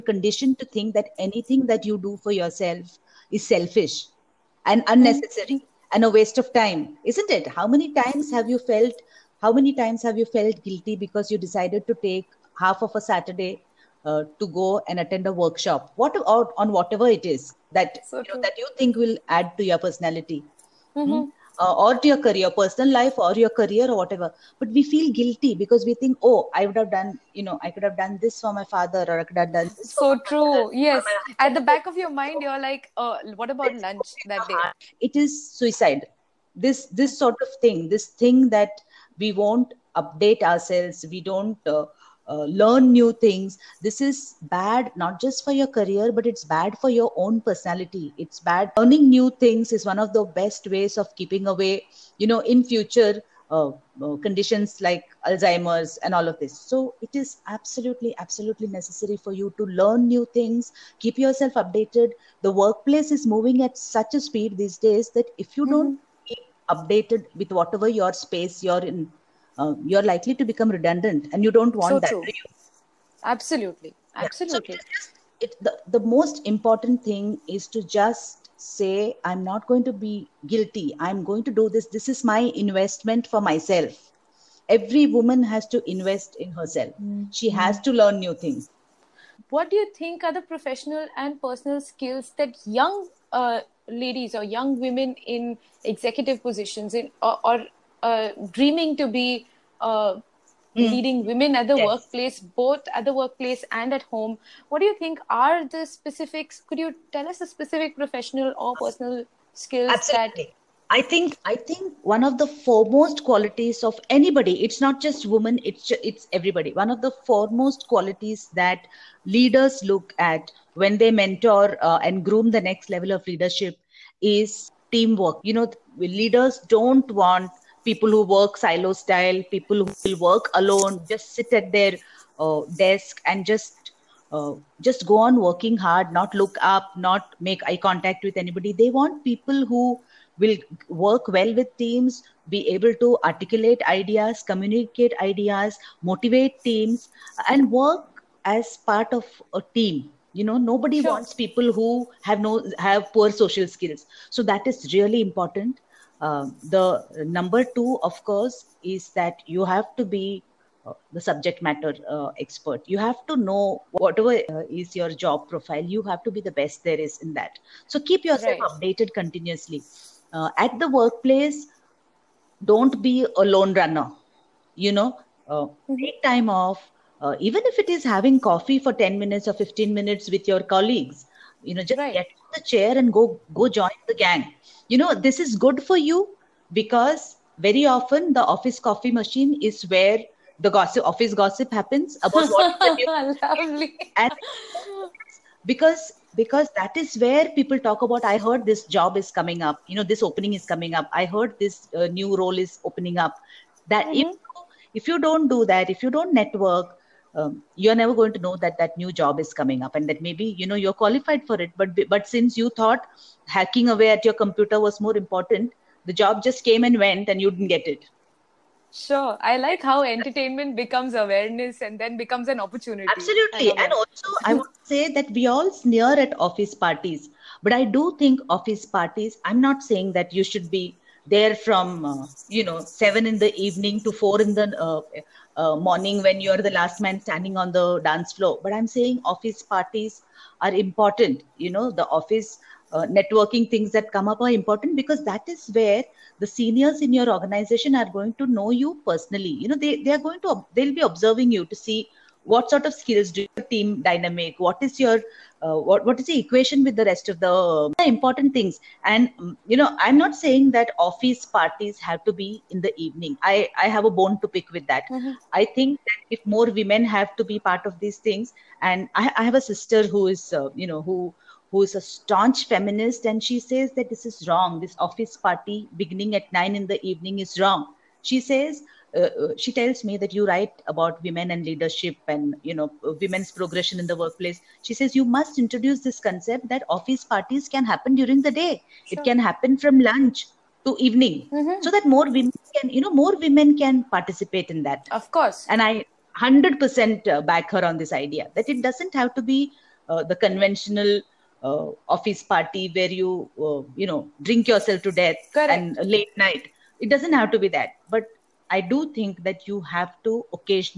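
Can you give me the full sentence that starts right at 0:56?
So it is absolutely, absolutely necessary for you to learn new things, keep yourself updated.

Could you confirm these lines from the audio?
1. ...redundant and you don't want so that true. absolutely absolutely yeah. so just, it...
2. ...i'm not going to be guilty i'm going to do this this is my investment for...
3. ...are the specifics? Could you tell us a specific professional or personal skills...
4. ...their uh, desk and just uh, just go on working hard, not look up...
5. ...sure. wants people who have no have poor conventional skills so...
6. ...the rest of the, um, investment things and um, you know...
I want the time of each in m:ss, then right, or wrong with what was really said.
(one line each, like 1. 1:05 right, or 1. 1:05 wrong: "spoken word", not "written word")
1. 1:10 right
2. 1:19 right
3. 1:45 right
4. 2:11 right
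5. 2:31 wrong: "social", not "conventional"
6. 4:16 wrong: "important", not "investment".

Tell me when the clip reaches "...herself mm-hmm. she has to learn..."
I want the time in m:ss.
1:26.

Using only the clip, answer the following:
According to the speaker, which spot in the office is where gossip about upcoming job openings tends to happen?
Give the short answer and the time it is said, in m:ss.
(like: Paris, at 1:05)
The office coffee machine, at 3:08.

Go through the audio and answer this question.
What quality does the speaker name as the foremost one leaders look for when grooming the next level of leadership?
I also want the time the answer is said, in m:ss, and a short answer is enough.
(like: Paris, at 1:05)
Teamwork, at 2:04.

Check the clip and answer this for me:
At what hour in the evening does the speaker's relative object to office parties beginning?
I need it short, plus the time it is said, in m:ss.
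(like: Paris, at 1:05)
9, at 4:36.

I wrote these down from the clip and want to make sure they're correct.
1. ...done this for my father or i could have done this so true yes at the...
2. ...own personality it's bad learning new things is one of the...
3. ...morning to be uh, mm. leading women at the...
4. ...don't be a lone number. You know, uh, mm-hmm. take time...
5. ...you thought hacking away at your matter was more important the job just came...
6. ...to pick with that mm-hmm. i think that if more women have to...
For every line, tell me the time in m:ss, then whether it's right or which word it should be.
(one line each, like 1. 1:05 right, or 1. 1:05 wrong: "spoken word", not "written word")
1. 0:27 right
2. 0:47 right
3. 1:38 wrong: "dreaming", not "morning"
4. 2:52 wrong: "runner", not "number"
5. 3:32 wrong: "computer", not "matter"
6. 4:24 right.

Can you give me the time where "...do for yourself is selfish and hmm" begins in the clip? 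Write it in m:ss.
0:02.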